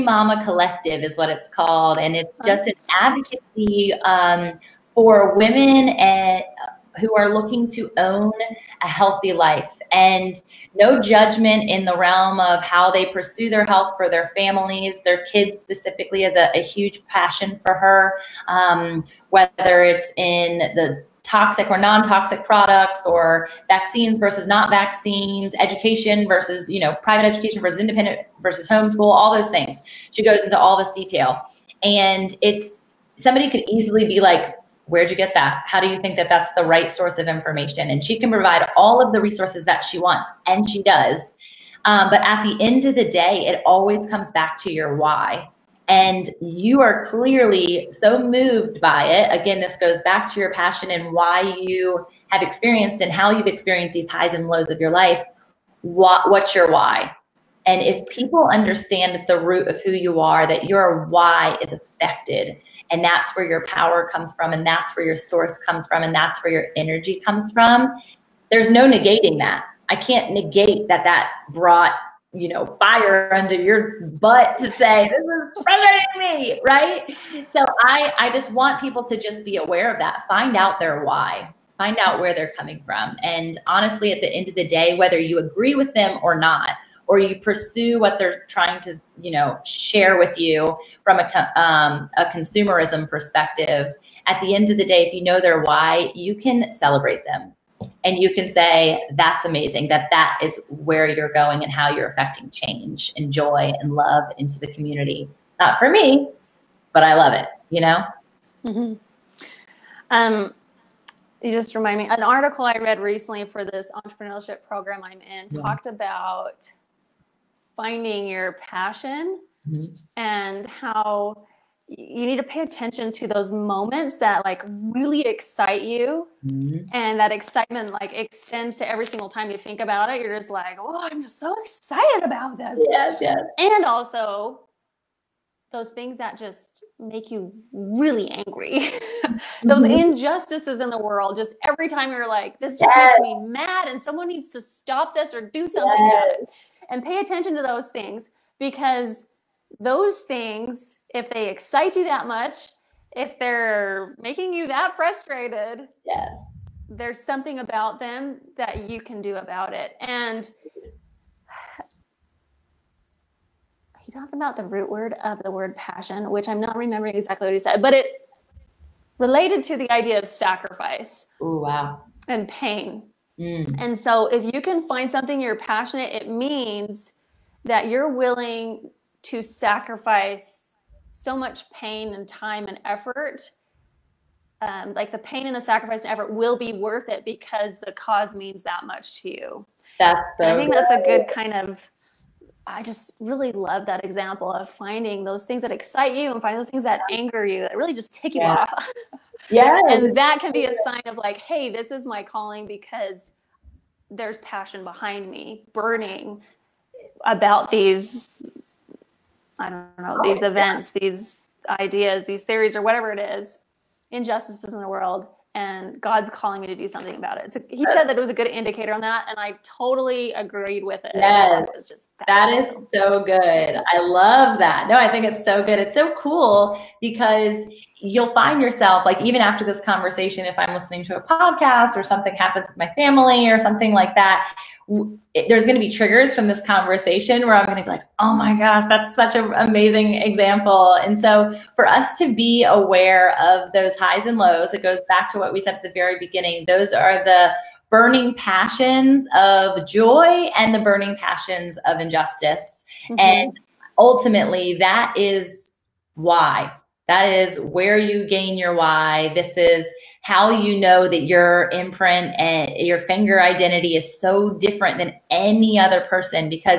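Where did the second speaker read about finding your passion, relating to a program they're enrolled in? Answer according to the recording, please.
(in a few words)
an article.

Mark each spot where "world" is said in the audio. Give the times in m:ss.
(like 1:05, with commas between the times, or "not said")
2:20, 3:34.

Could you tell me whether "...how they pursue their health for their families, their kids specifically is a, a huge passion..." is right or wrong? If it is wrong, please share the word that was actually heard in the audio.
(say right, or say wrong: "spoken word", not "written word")
right.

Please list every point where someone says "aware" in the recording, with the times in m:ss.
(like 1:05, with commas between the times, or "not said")
1:19, 4:02.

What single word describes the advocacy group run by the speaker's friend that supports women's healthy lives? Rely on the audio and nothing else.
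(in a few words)
collective.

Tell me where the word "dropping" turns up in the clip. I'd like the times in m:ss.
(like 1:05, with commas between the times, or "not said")
not said.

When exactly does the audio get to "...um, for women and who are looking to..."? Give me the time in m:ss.
0:04.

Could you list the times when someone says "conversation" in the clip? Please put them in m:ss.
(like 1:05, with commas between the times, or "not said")
3:49, 3:56.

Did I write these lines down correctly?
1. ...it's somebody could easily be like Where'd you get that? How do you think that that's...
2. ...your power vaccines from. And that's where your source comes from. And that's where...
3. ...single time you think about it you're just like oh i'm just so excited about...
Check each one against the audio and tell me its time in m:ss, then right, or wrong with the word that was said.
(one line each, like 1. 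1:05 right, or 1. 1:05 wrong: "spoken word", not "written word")
1. 0:32 right
2. 1:03 wrong: "comes", not "vaccines"
3. 2:09 right.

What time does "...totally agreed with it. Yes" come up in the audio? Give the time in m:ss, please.
3:39.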